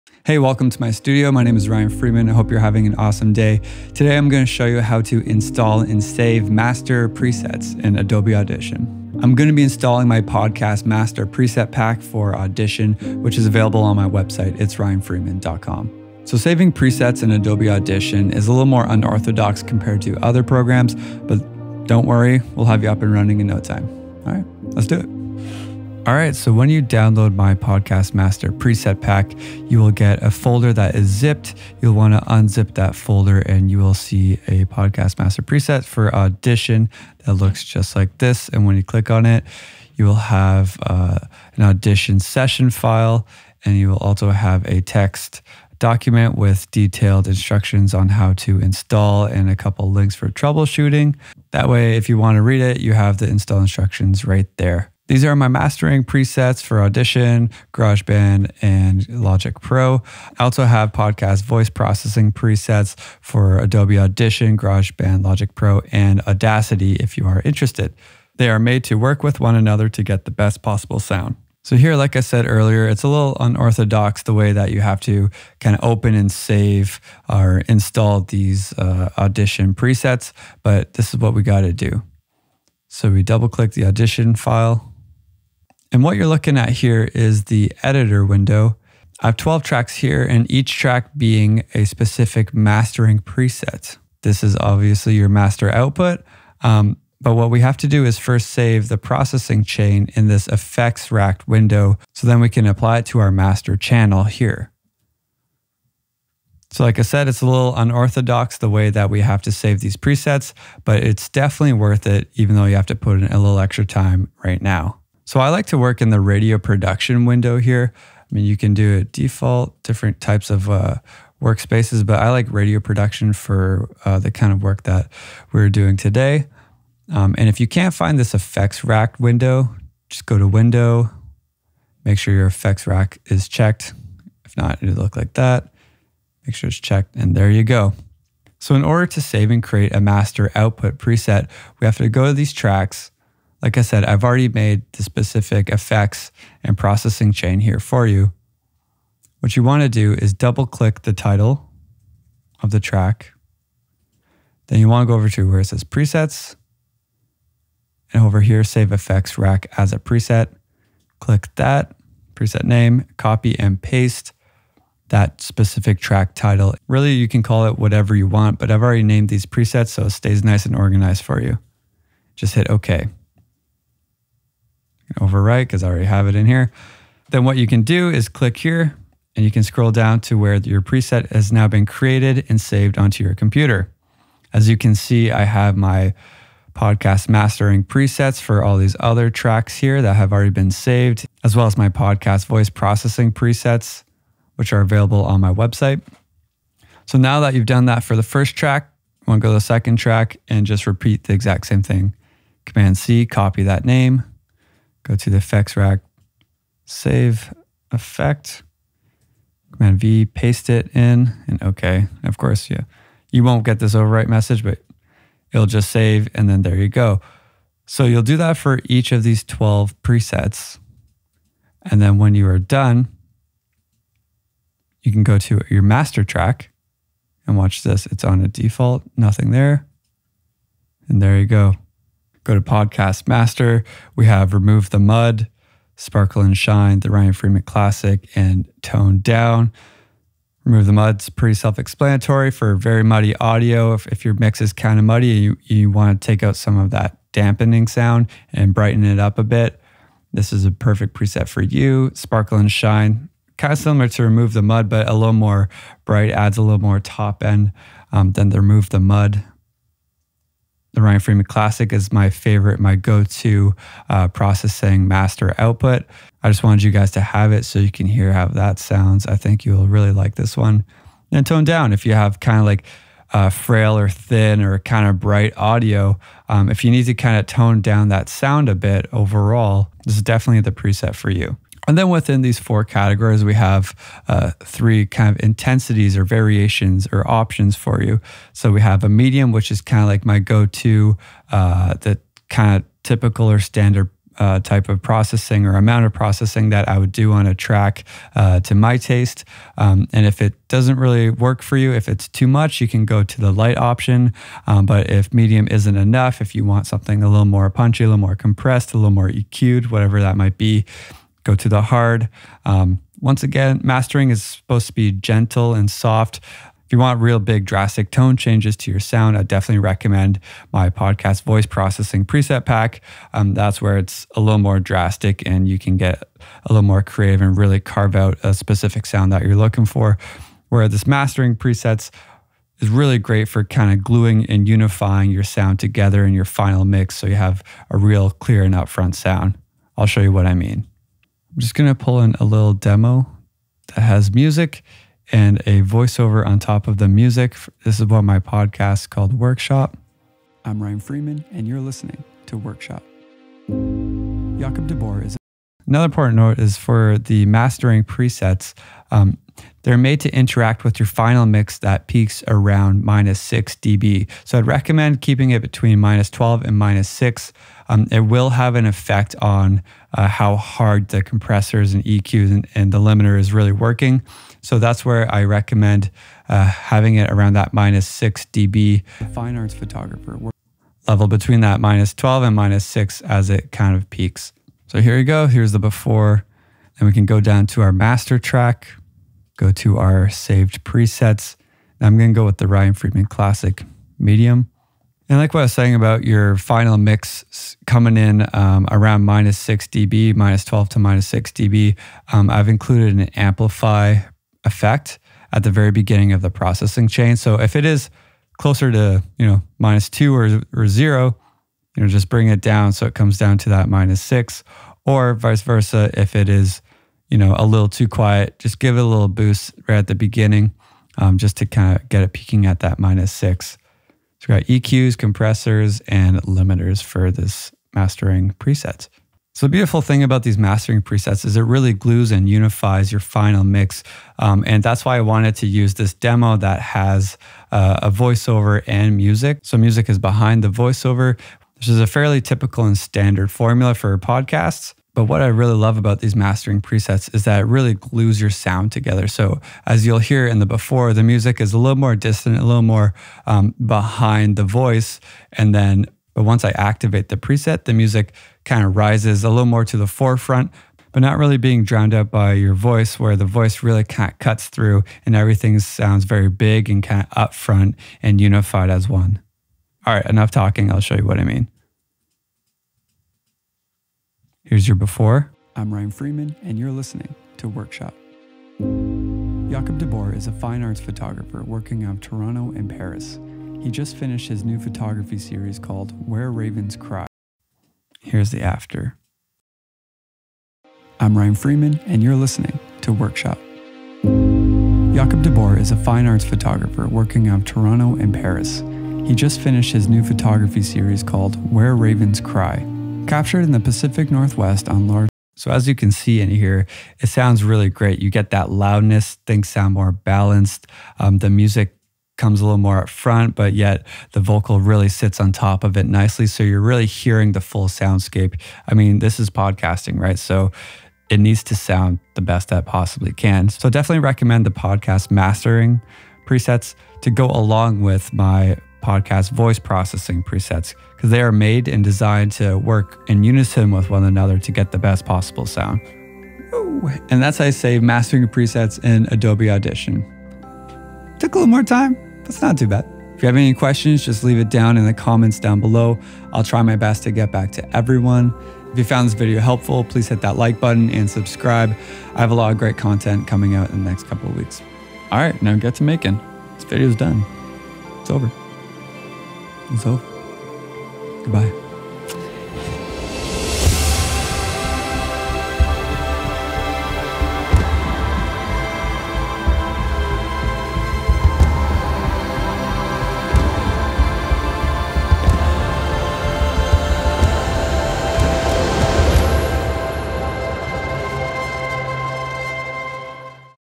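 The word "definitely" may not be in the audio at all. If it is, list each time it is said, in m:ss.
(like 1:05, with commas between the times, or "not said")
1:51, 4:40, 5:19, 8:43.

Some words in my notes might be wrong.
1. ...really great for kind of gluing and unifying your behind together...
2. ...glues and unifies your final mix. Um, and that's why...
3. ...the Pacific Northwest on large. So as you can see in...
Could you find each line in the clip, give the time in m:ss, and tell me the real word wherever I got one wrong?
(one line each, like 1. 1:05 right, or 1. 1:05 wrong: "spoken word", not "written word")
1. 5:32 wrong: "sound", not "behind"
2. 7:11 right
3. 8:23 right.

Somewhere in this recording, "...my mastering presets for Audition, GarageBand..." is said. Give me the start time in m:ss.
0:55.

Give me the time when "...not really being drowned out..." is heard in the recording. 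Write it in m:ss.
7:41.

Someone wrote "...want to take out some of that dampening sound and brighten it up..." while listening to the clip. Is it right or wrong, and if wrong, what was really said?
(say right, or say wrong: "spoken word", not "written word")
right.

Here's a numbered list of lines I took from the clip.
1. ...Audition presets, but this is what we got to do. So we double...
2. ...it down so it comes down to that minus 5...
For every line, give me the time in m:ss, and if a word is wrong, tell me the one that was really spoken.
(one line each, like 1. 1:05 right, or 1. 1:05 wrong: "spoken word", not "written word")
1. 1:19 right
2. 6:52 wrong: "6", not "5".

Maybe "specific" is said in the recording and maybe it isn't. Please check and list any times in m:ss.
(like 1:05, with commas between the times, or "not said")
1:31, 2:25, 2:45, 5:28.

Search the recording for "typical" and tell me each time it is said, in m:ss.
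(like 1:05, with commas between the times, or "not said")
4:53, 7:22.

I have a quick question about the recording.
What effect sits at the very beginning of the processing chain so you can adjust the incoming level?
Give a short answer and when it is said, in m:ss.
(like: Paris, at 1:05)
amplify, at 6:43.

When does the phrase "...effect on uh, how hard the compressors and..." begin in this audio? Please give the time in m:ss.
6:08.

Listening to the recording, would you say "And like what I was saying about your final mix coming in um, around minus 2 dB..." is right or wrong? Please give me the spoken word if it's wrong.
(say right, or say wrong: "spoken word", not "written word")
wrong: "6", not "2".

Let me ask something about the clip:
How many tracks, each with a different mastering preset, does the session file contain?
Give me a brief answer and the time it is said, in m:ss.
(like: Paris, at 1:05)
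12, at 1:29.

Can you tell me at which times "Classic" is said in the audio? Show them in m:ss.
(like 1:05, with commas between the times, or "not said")
3:57, 4:21, 6:33.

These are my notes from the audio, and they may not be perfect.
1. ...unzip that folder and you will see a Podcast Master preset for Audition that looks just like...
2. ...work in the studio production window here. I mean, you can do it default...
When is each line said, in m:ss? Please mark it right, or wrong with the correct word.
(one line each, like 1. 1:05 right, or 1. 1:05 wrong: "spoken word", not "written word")
1. 0:32 right
2. 1:55 wrong: "radio", not "studio".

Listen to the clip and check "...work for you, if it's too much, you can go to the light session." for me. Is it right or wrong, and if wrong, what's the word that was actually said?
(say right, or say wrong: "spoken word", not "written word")
wrong: "option", not "session".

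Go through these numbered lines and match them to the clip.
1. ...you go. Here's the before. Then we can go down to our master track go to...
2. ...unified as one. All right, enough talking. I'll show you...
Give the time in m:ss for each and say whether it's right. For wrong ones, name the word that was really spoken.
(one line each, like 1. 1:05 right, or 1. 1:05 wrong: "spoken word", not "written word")
1. 6:25 right
2. 7:48 right.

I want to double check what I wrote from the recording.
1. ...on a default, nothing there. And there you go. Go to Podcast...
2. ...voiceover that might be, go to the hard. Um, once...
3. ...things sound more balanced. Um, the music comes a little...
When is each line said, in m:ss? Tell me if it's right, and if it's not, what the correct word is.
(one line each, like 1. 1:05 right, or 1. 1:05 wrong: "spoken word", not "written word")
1. 3:48 right
2. 5:09 wrong: "whatever", not "voiceover"
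3. 8:29 right.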